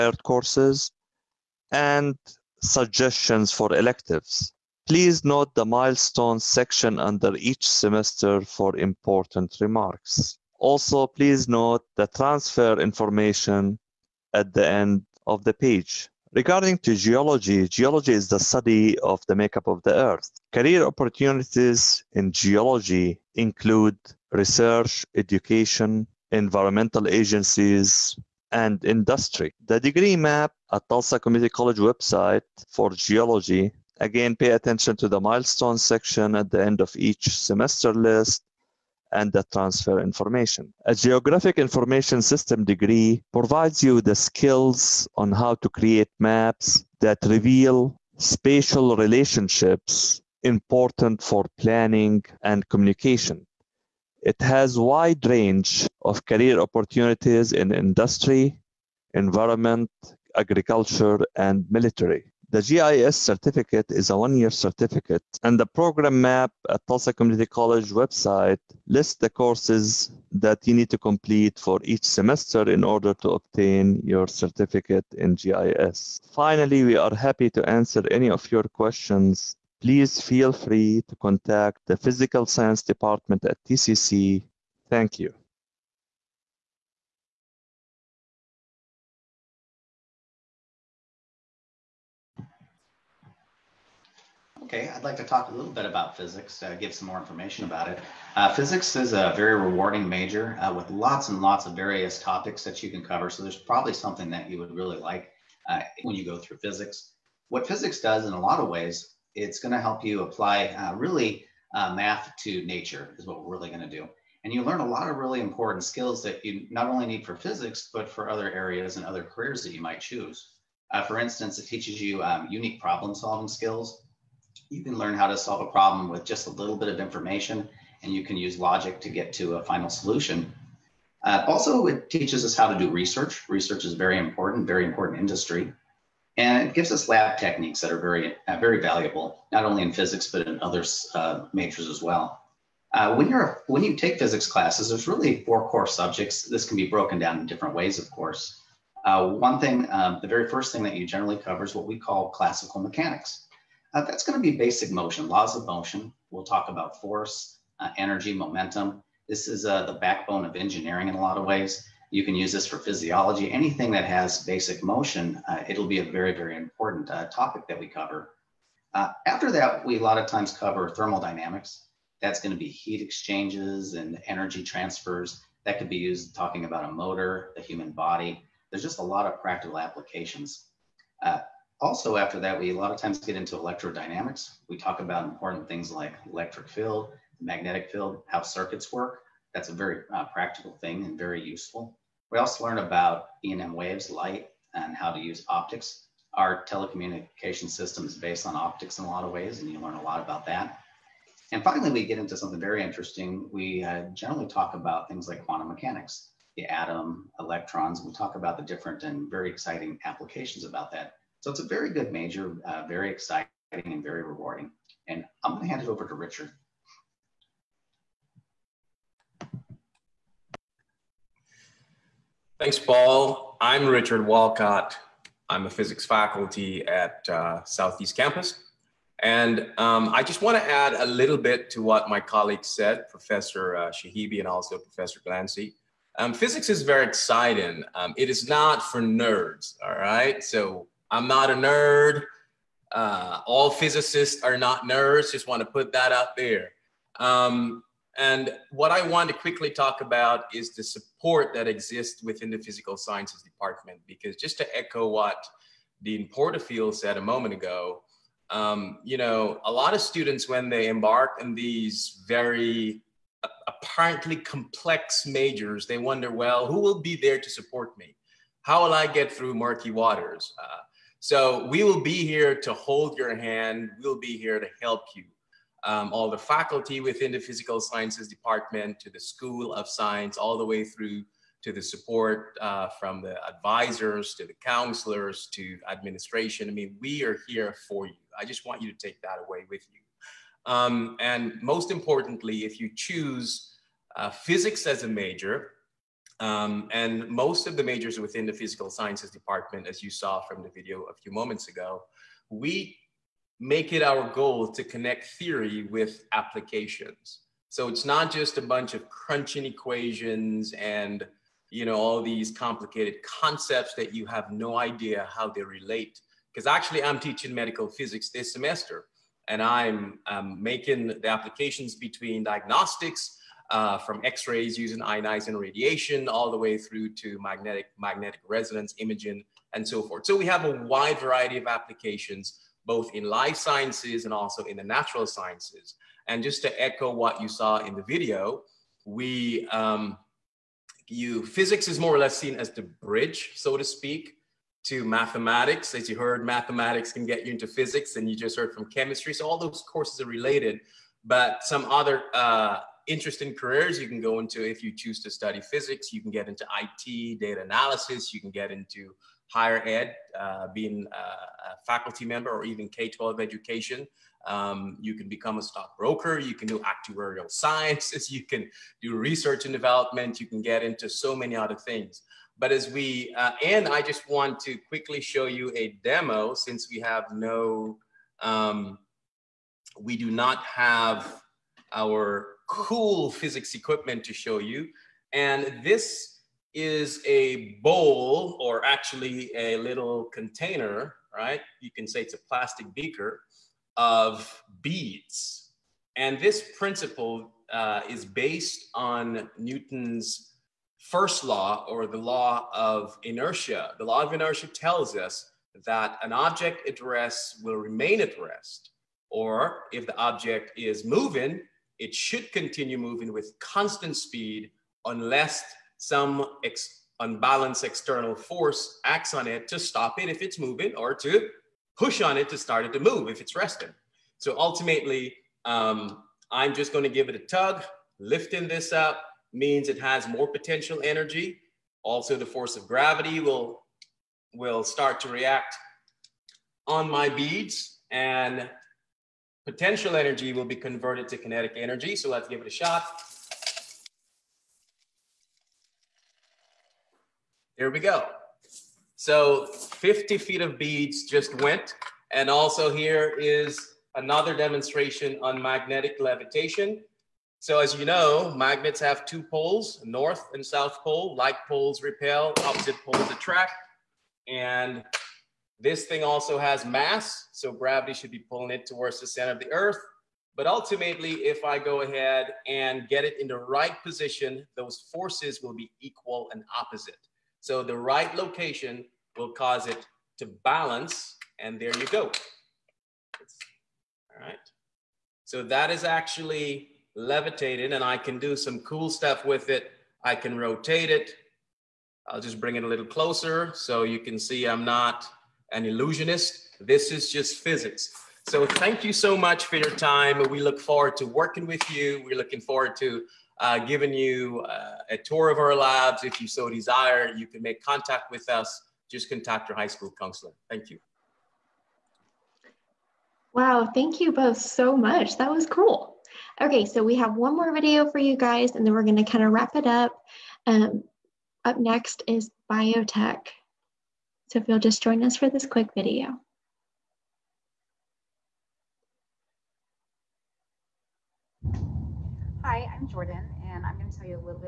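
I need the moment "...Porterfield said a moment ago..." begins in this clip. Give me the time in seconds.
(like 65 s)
256 s.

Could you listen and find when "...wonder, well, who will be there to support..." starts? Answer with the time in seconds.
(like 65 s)
265 s.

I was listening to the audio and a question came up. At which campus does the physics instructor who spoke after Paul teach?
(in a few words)
Southeast Campus.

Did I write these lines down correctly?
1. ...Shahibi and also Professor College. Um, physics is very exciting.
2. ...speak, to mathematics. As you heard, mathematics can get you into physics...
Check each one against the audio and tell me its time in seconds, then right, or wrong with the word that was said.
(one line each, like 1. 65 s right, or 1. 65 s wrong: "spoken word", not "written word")
1. 233 s wrong: "Glancy", not "College"
2. 343 s right.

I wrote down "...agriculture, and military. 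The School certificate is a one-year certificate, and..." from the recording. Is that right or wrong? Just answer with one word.
wrong.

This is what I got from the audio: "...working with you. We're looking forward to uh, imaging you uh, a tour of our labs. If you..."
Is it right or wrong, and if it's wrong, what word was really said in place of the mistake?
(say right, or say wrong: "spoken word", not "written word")
wrong: "giving", not "imaging".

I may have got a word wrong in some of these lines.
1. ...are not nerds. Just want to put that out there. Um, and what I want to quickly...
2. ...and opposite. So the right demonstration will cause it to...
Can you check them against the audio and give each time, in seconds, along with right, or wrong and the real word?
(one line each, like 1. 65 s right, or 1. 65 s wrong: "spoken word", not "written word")
1. 244 s right
2. 476 s wrong: "location", not "demonstration".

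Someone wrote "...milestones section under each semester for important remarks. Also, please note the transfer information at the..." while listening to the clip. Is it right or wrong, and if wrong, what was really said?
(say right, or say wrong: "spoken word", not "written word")
right.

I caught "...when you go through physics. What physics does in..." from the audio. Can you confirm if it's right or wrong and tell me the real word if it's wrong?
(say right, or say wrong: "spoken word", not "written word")
right.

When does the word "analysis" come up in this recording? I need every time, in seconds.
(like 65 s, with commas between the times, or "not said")
357 s.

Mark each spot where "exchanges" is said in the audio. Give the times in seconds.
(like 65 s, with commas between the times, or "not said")
173 s.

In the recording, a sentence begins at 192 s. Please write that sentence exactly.
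We also learn about E&M waves, light, and how to use optics.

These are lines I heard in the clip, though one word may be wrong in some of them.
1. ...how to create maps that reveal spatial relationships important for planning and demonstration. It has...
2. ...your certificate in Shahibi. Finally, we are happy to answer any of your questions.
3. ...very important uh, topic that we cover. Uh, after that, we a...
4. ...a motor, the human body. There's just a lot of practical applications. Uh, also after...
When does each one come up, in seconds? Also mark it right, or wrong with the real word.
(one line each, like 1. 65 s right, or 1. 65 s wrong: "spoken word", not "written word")
1. 45 s wrong: "communication", not "demonstration"
2. 74 s wrong: "GIS", not "Shahibi"
3. 166 s right
4. 176 s right.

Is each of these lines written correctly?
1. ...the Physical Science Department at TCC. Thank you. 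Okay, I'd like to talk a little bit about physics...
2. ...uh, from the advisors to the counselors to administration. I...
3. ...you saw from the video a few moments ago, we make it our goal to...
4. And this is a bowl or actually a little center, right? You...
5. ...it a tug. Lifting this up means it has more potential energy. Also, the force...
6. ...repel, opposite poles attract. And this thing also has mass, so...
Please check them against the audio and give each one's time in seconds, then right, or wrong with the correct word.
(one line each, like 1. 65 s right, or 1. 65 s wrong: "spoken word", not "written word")
1. 81 s right
2. 282 s right
3. 300 s right
4. 385 s wrong: "container", not "center"
5. 427 s right
6. 462 s right.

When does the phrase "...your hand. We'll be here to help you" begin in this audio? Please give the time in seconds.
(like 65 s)
273 s.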